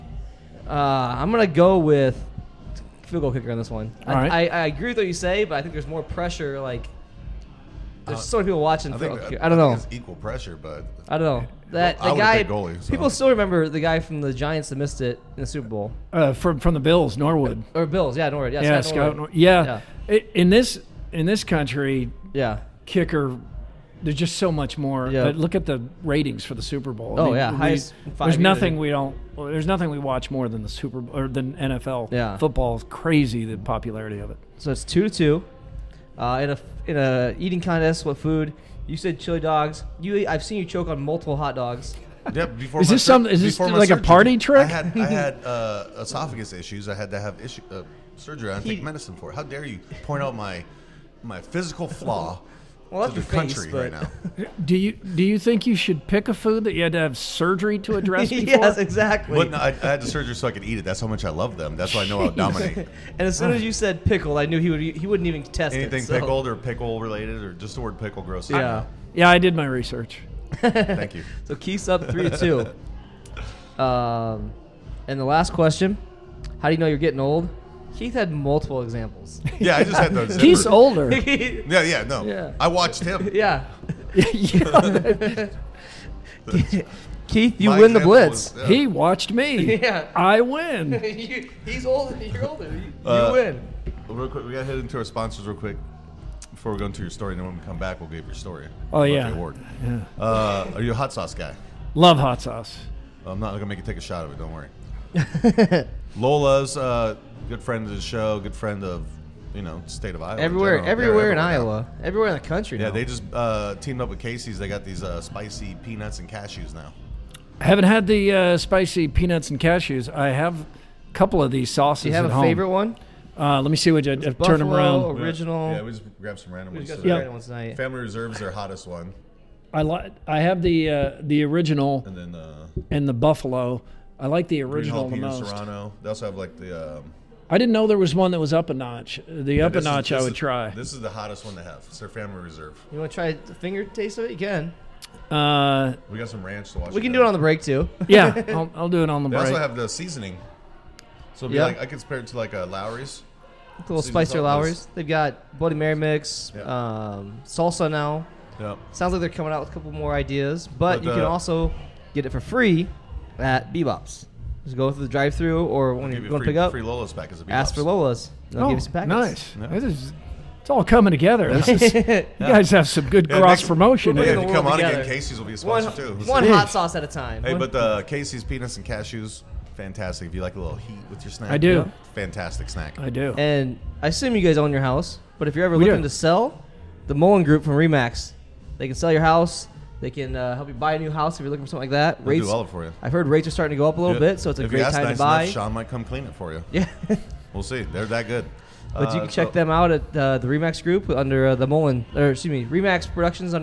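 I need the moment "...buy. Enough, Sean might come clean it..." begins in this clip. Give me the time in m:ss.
3:15.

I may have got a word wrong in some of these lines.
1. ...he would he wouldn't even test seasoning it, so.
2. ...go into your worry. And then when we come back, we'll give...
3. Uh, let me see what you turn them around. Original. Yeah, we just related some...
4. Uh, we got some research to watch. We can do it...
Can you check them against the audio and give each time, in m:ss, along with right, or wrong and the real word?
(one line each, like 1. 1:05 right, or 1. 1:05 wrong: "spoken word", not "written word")
1. 1:04 wrong: "anything", not "seasoning"
2. 1:36 wrong: "story", not "worry"
3. 2:03 wrong: "grabbed", not "related"
4. 2:25 wrong: "ranch", not "research".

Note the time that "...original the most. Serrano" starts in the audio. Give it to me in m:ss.
2:14.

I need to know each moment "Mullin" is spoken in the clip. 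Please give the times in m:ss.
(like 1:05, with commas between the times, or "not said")
3:07, 3:21.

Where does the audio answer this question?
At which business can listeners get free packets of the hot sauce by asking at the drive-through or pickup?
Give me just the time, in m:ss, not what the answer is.
2:43.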